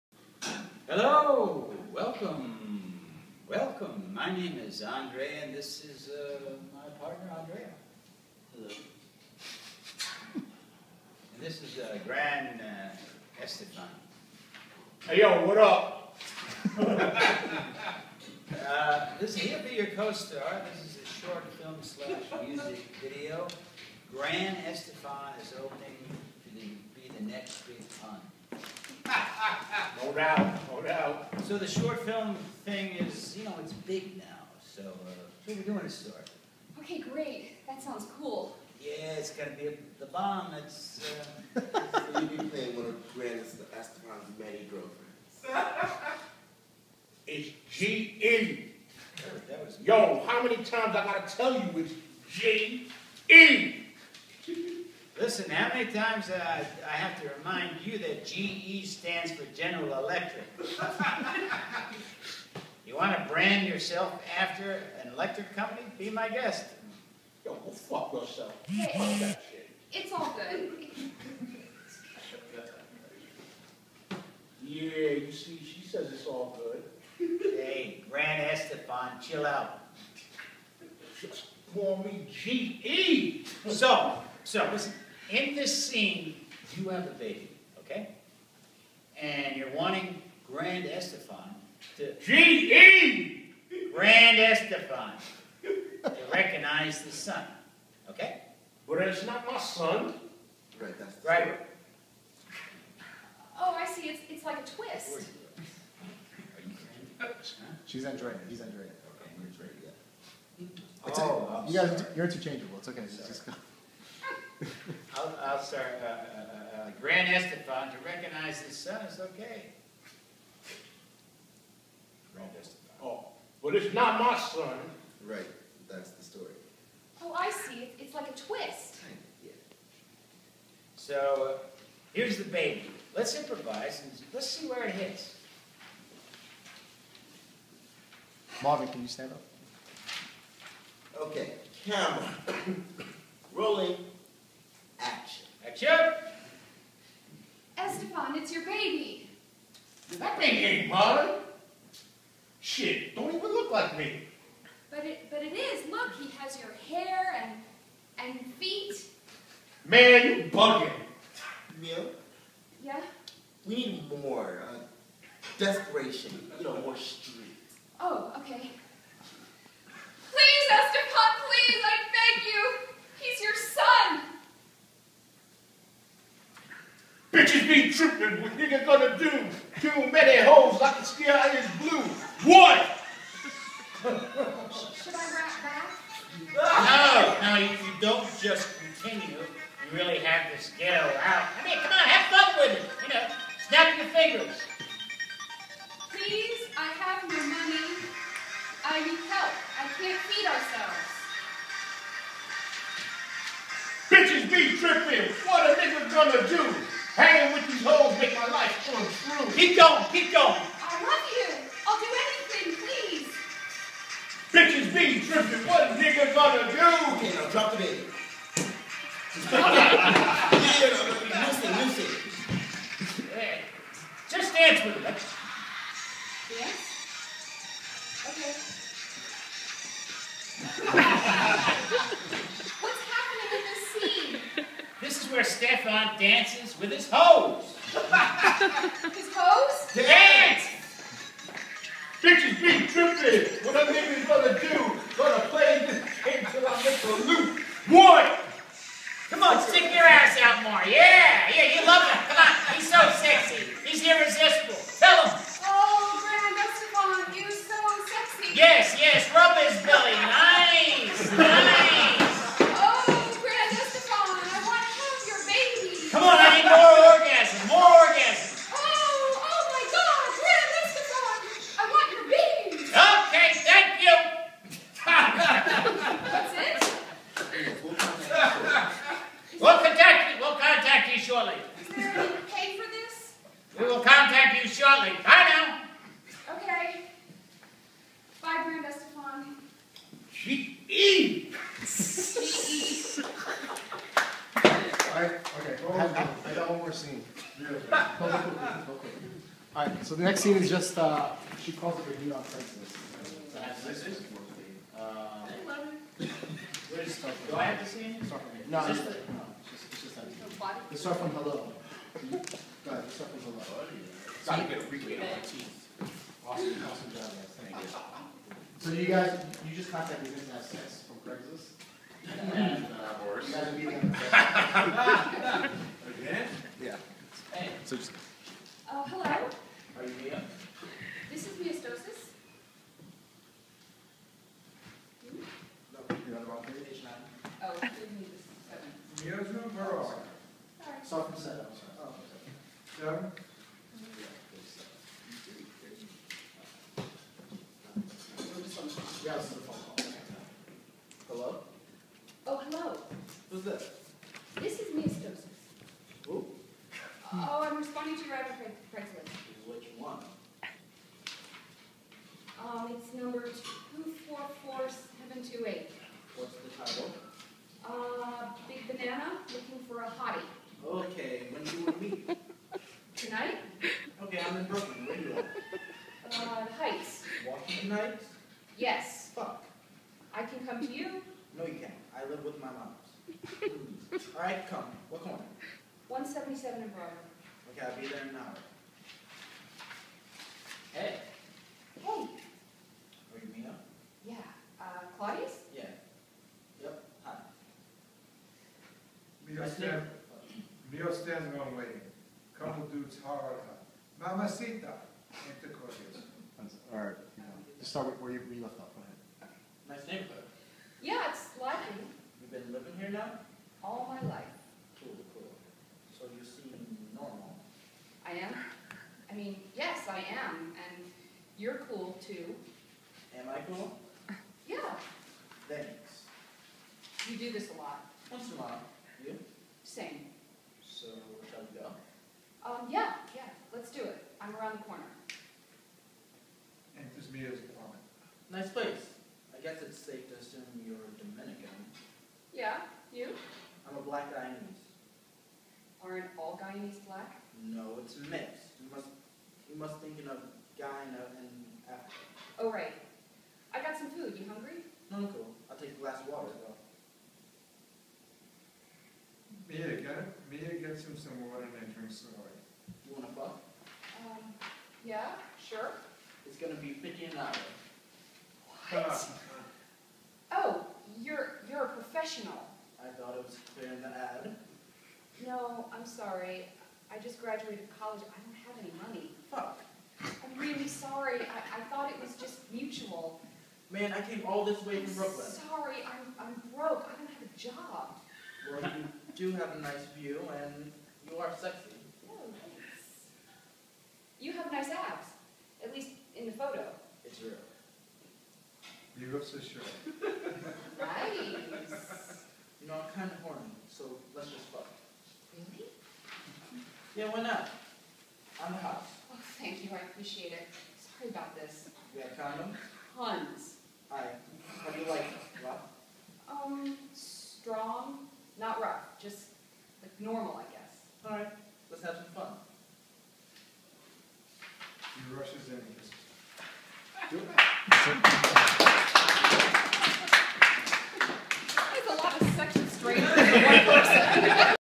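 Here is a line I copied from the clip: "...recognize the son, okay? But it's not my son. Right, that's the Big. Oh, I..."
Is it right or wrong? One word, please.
wrong.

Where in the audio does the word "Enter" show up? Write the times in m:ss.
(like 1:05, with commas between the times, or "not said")
6:45, 7:16.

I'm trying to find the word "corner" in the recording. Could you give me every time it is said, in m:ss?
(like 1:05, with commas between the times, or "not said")
6:25, 7:14.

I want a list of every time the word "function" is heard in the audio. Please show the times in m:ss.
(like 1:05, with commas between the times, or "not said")
not said.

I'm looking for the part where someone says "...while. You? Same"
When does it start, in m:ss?
7:08.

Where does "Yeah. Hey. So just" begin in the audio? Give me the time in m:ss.
5:26.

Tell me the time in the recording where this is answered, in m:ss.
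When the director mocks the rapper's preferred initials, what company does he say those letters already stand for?
0:59.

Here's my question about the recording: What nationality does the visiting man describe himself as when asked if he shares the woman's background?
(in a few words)
Black Guyanese.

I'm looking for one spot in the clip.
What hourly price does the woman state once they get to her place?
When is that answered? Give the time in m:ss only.
7:46.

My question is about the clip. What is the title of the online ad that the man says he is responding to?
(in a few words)
Big Banana, looking for a hottie.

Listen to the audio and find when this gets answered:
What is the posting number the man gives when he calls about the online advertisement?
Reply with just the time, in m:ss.
6:03.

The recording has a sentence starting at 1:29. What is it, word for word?
And you're wanting Grand Estefan to...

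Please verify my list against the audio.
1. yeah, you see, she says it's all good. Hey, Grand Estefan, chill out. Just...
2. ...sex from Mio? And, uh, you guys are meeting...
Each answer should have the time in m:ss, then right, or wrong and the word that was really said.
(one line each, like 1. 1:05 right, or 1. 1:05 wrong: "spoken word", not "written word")
1. 1:14 right
2. 5:20 wrong: "Craigslist", not "Mio".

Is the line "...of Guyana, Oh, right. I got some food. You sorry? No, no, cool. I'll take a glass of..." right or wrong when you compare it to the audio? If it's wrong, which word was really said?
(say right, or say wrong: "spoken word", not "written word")
wrong: "hungry", not "sorry".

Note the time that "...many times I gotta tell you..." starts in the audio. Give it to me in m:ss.
0:50.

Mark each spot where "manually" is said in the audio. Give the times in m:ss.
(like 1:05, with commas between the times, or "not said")
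not said.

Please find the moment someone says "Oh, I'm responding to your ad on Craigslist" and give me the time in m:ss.
5:57.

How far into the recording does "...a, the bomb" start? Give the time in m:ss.
0:39.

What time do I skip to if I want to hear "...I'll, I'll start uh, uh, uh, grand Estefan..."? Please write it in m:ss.
1:55.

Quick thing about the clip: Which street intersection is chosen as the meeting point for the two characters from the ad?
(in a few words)
177 and Broadway.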